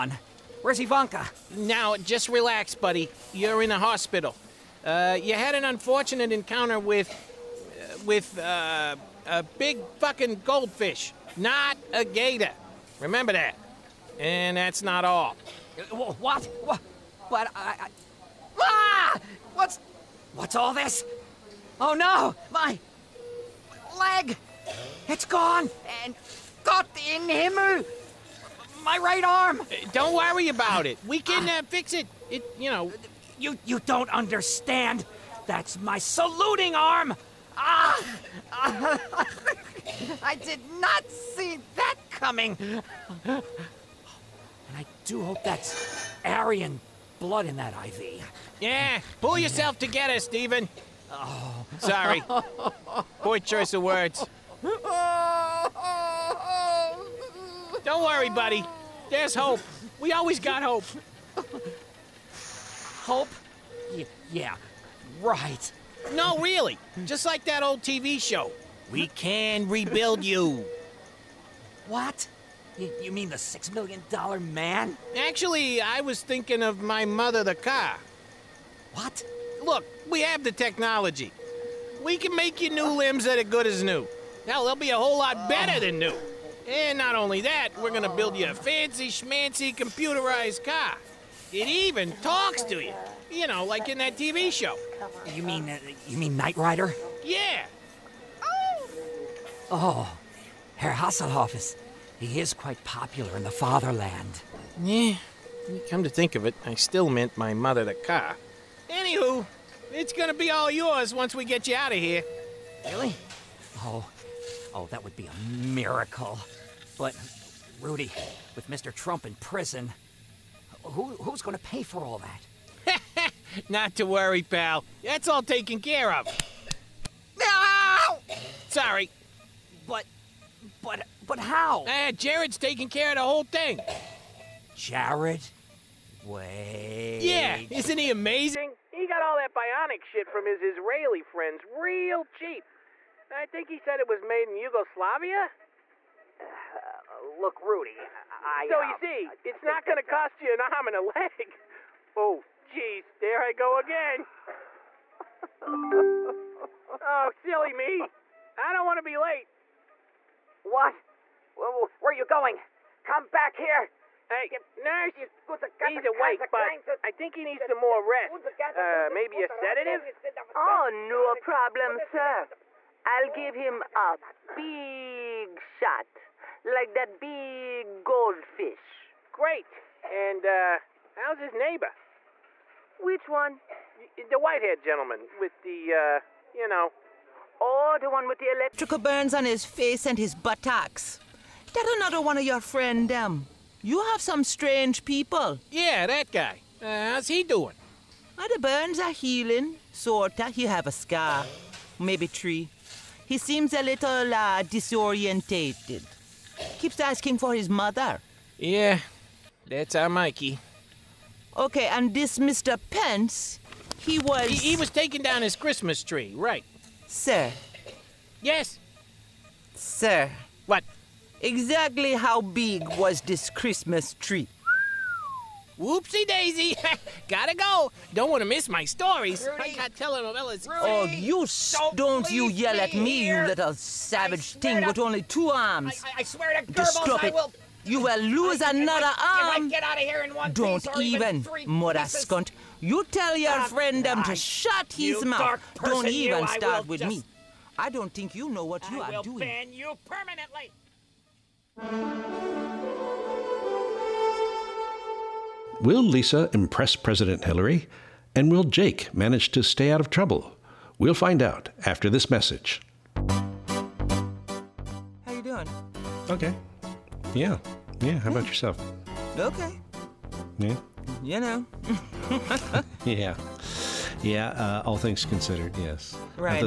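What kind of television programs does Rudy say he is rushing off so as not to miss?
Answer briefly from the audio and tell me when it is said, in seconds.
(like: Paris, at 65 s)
Telenovelas, at 229 s.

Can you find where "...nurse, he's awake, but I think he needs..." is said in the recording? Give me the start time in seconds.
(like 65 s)
164 s.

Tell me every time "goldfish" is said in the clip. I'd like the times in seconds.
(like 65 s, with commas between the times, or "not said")
10 s, 178 s.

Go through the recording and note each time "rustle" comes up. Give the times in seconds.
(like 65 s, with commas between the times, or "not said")
not said.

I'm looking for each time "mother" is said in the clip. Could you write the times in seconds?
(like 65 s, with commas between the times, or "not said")
77 s, 107 s, 207 s, 241 s.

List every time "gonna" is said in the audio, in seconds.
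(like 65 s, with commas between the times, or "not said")
87 s, 110 s, 121 s.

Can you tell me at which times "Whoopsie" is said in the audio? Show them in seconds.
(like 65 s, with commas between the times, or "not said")
225 s.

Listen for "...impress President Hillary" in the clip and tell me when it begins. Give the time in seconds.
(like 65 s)
256 s.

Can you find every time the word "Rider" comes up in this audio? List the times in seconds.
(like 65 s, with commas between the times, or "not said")
96 s.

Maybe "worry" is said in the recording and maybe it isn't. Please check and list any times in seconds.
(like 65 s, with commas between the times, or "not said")
30 s, 58 s, 124 s.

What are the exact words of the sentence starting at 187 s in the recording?
Oh, the one with the electrical burns on his face and his buttocks.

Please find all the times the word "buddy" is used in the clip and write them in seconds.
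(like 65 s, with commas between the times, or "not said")
2 s, 58 s.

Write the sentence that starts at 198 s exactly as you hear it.
Well, ah, the burns are healing, sorta.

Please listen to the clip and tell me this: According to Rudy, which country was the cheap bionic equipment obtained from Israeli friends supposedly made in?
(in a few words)
Yugoslavia.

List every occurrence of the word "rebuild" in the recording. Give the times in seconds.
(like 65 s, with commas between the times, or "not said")
69 s.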